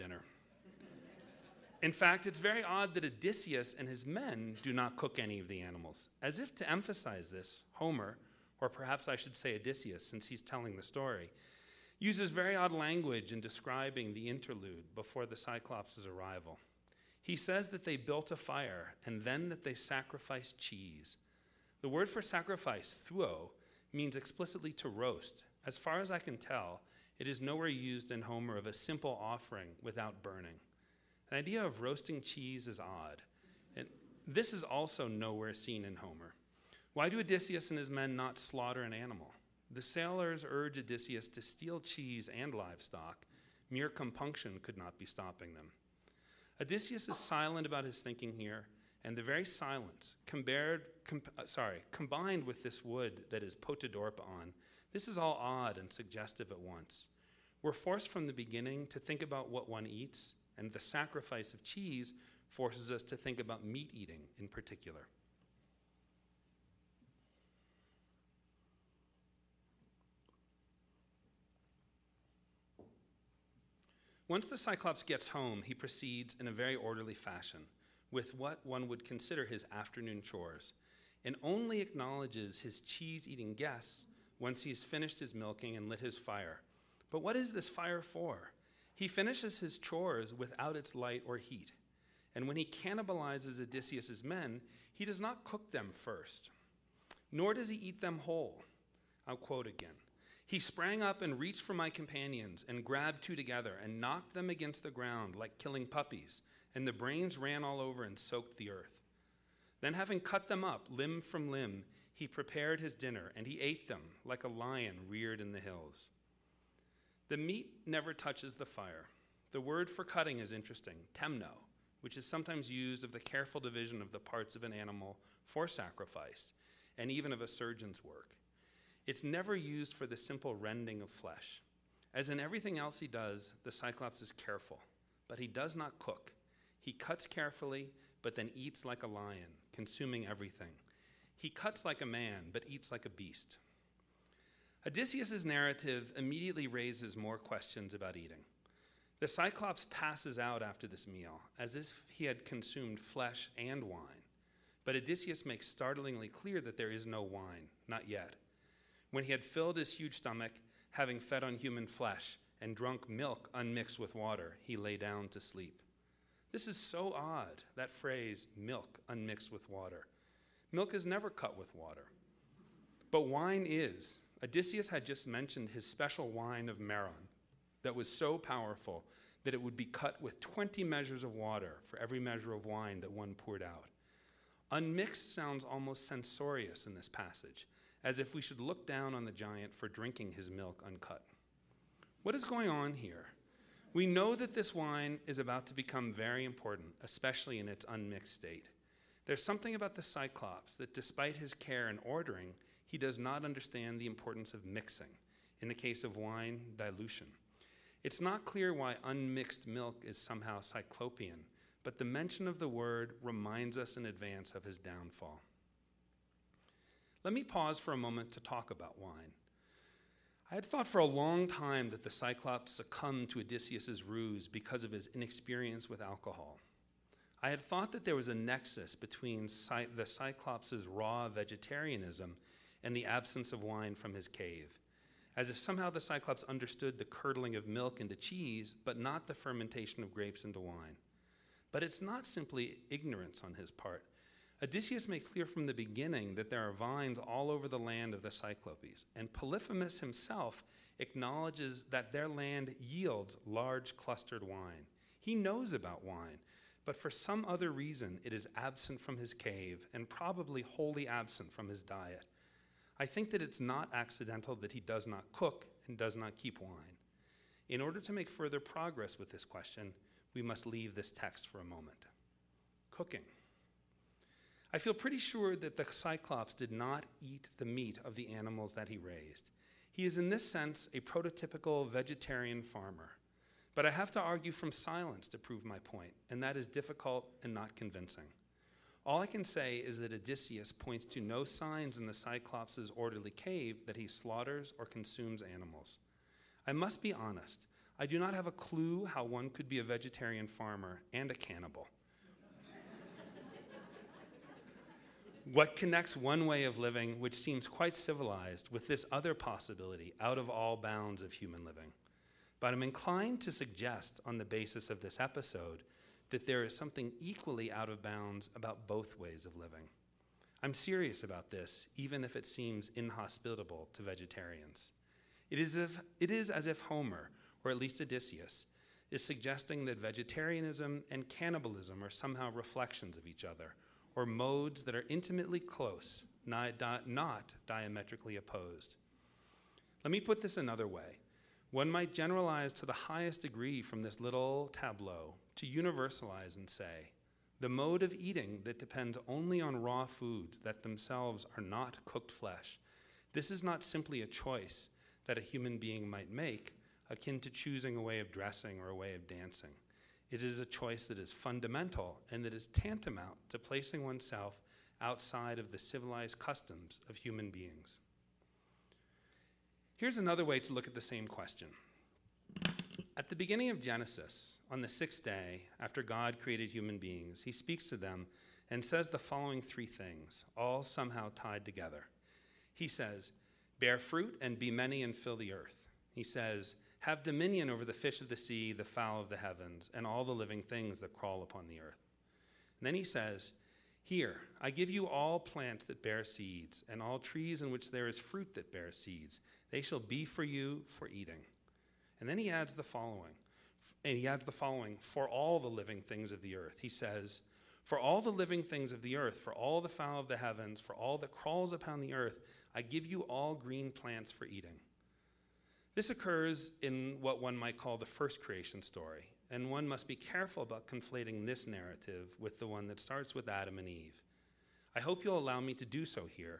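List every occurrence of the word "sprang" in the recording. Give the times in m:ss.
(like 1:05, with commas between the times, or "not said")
1:40.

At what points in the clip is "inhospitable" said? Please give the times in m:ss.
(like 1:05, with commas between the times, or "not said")
5:22.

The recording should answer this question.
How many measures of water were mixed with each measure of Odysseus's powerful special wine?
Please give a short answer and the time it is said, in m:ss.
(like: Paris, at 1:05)
20, at 3:00.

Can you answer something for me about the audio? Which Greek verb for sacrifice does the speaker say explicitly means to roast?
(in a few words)
thuo.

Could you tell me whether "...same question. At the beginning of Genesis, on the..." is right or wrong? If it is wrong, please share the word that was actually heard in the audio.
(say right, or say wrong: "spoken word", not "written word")
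right.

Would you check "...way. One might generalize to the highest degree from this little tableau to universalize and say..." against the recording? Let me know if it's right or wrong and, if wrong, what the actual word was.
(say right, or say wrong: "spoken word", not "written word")
right.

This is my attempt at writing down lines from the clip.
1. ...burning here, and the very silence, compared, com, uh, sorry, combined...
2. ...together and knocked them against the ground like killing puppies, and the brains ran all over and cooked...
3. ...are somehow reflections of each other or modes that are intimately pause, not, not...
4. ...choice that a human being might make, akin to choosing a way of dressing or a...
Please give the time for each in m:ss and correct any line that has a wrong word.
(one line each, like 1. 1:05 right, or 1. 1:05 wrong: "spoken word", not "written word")
1. 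0:48 wrong: "thinking", not "burning"
2. 1:43 wrong: "soaked", not "cooked"
3. 5:32 wrong: "close", not "pause"
4. 5:54 right.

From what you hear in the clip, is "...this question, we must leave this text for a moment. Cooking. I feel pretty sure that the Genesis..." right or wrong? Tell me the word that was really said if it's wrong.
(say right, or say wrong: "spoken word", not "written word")
wrong: "Cyclops", not "Genesis".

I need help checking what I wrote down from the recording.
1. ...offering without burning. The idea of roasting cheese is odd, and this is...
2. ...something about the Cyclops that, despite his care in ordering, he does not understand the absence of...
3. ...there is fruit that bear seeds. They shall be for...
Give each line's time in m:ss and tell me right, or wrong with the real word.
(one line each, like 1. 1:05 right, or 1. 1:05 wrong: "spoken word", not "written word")
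1. 0:29 right
2. 3:19 wrong: "importance", not "absence"
3. 6:37 right.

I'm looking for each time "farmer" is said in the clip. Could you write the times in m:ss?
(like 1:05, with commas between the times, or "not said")
4:42, 5:00.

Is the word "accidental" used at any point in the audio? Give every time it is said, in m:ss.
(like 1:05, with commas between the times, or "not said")
4:23.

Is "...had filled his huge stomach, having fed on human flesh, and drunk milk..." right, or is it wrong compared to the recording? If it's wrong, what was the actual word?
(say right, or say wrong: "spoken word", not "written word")
right.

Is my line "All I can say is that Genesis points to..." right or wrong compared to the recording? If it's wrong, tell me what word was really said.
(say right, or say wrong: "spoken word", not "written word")
wrong: "Odysseus", not "Genesis".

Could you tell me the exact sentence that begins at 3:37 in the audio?
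Let me pause for a moment to talk about wine.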